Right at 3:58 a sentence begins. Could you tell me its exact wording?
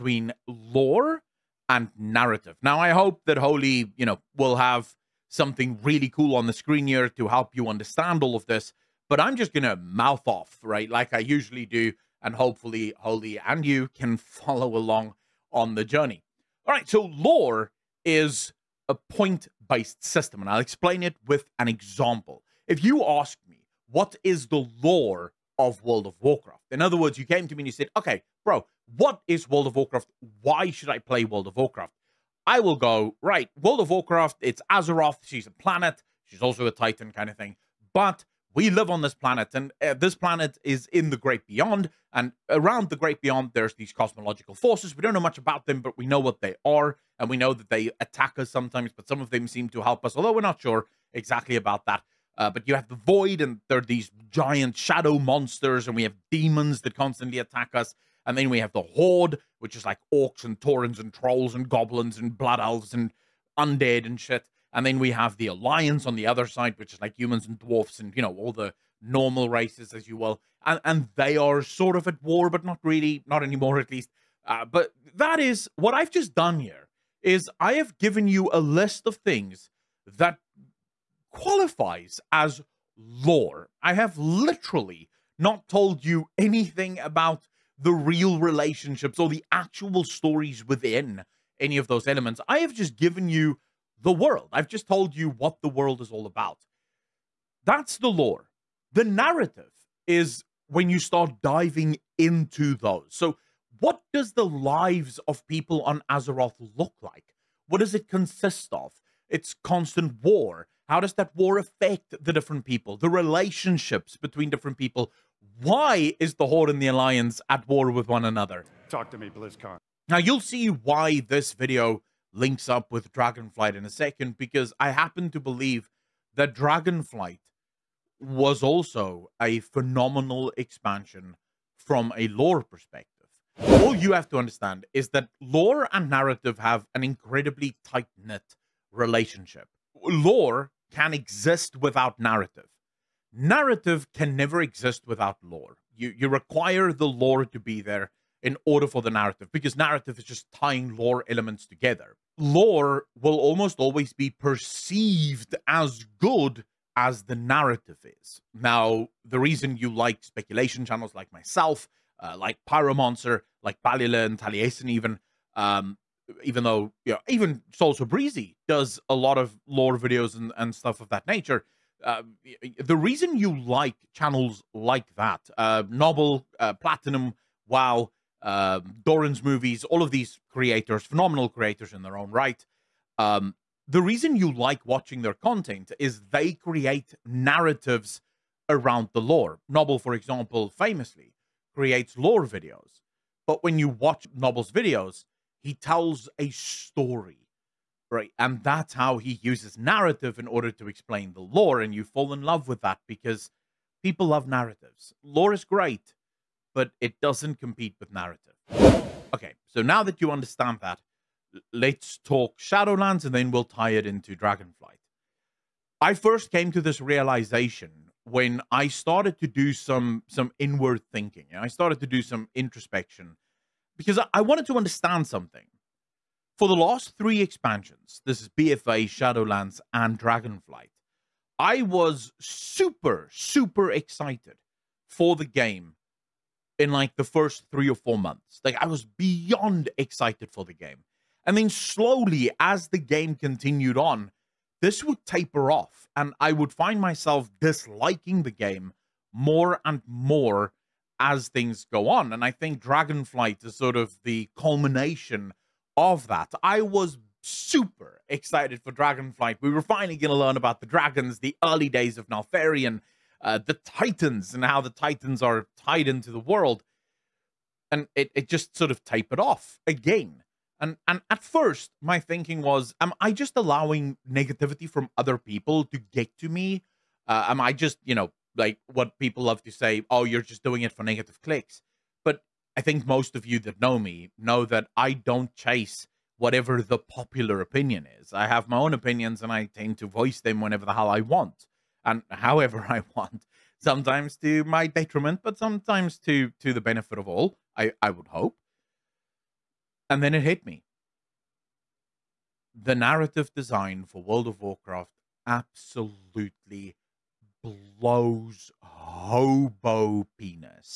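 Like I was beyond excited for the game.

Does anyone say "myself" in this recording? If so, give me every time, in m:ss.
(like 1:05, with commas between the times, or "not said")
2:41, 4:07.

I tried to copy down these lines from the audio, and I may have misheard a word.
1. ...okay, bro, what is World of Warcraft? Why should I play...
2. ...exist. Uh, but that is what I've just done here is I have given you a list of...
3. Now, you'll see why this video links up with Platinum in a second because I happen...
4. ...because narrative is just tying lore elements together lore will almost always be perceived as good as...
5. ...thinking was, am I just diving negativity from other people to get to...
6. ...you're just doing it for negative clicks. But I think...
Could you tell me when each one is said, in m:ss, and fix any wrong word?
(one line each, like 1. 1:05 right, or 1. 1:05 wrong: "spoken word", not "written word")
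1. 0:27 right
2. 1:13 wrong: "least", not "exist"
3. 2:00 wrong: "Dragonflight", not "Platinum"
4. 2:29 right
5. 4:32 wrong: "allowing", not "diving"
6. 4:40 right.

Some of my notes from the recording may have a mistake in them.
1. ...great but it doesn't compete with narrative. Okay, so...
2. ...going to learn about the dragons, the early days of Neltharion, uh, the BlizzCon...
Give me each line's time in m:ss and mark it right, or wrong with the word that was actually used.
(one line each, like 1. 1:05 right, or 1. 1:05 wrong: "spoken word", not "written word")
1. 3:25 right
2. 4:20 wrong: "Titans", not "BlizzCon".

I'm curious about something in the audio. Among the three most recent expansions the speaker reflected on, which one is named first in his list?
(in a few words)
BFA.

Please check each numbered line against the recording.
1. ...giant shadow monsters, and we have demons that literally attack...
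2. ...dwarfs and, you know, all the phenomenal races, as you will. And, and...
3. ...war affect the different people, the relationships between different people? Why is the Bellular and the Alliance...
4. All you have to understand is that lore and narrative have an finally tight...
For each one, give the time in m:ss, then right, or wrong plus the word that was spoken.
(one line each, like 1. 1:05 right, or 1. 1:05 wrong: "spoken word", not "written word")
1. 0:54 wrong: "constantly", not "literally"
2. 1:07 wrong: "normal", not "phenomenal"
3. 1:51 wrong: "Horde", not "Bellular"
4. 2:13 wrong: "incredibly", not "finally".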